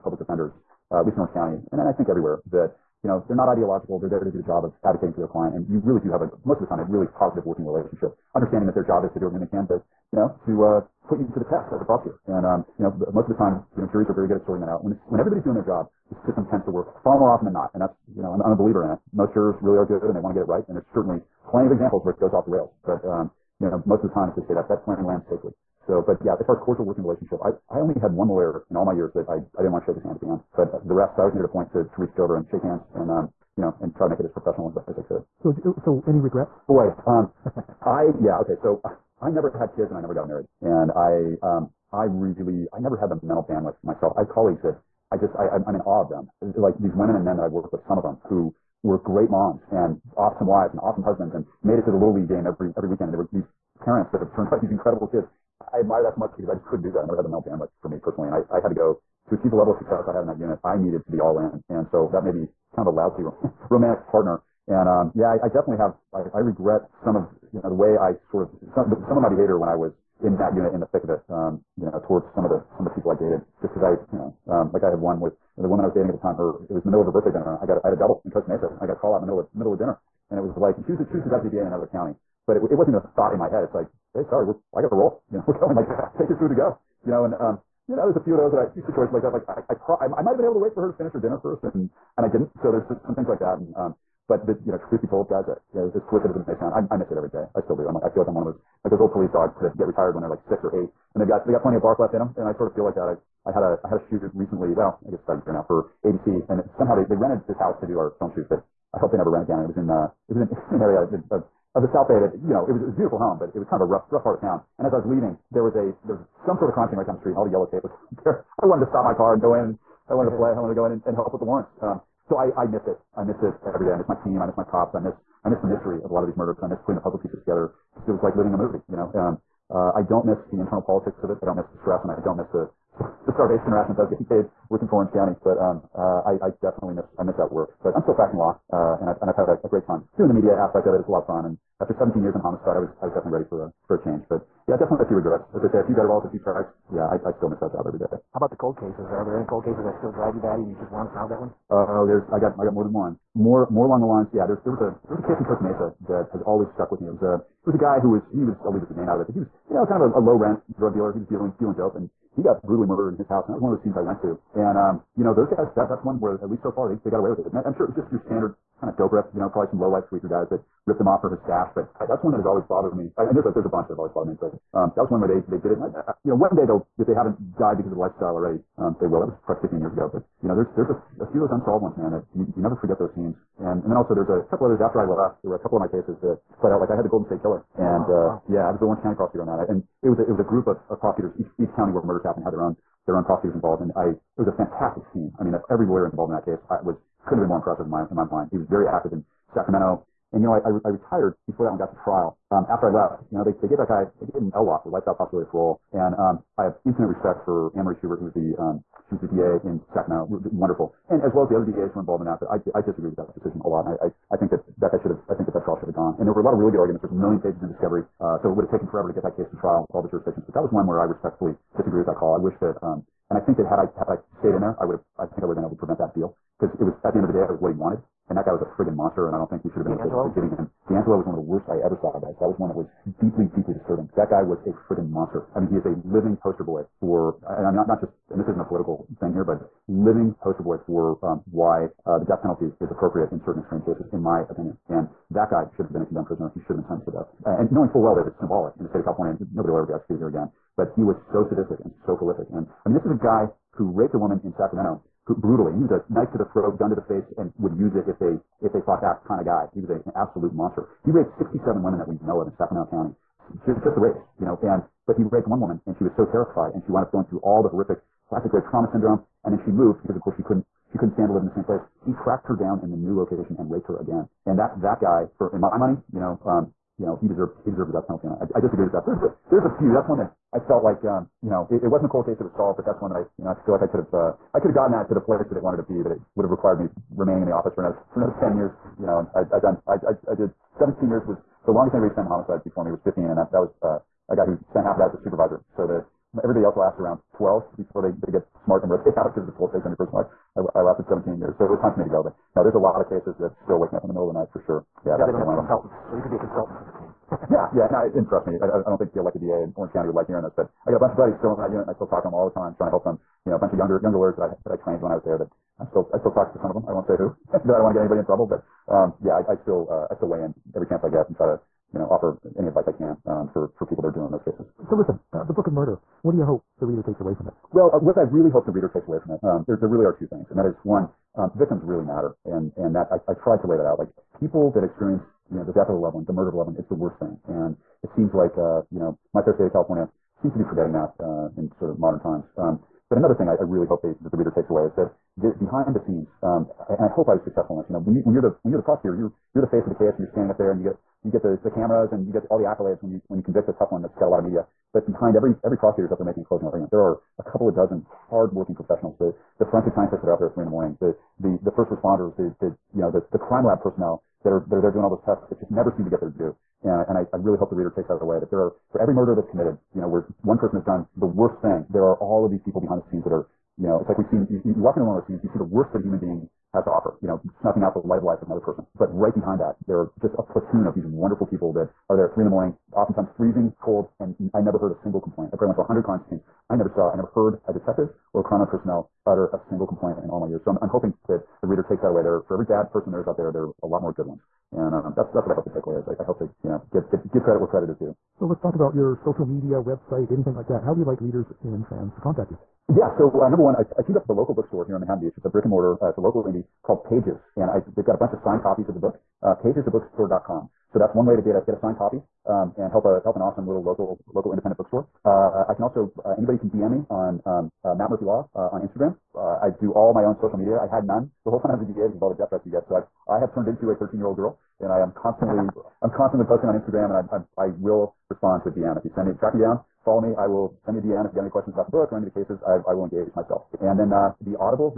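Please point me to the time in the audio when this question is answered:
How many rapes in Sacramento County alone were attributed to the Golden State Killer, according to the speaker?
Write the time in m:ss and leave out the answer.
4:21.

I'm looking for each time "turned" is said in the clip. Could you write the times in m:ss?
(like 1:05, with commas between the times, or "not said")
0:54, 7:03.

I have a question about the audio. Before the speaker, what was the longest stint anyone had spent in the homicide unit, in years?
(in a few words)
15.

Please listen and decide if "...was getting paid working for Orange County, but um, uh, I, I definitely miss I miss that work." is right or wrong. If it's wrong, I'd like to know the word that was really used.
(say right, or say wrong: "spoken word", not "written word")
right.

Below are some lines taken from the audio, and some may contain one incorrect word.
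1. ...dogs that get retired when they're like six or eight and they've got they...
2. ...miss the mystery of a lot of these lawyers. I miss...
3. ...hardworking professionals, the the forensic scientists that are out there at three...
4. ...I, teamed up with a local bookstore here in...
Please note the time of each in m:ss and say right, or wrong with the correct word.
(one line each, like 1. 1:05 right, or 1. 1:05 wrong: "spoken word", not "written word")
1. 1:39 right
2. 2:05 wrong: "murders", not "lawyers"
3. 5:58 right
4. 6:43 right.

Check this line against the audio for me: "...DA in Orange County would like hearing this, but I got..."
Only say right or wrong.
right.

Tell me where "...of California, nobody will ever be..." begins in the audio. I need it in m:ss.
4:08.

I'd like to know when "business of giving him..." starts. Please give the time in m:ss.
3:50.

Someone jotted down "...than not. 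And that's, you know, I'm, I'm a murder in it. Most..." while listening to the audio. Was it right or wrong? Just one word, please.
wrong.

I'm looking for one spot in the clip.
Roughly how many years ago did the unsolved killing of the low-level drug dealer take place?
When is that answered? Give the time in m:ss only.
2:59.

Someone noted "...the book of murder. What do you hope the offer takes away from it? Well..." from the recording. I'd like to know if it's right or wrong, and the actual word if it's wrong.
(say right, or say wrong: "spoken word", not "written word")
wrong: "reader", not "offer".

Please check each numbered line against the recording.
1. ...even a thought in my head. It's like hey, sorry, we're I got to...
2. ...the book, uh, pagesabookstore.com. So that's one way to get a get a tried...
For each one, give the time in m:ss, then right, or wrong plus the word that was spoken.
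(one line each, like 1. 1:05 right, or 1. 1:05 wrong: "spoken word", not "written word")
1. 1:22 right
2. 6:48 wrong: "signed", not "tried".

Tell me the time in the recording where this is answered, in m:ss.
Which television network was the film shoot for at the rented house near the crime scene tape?
1:46.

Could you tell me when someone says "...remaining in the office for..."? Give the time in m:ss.
4:47.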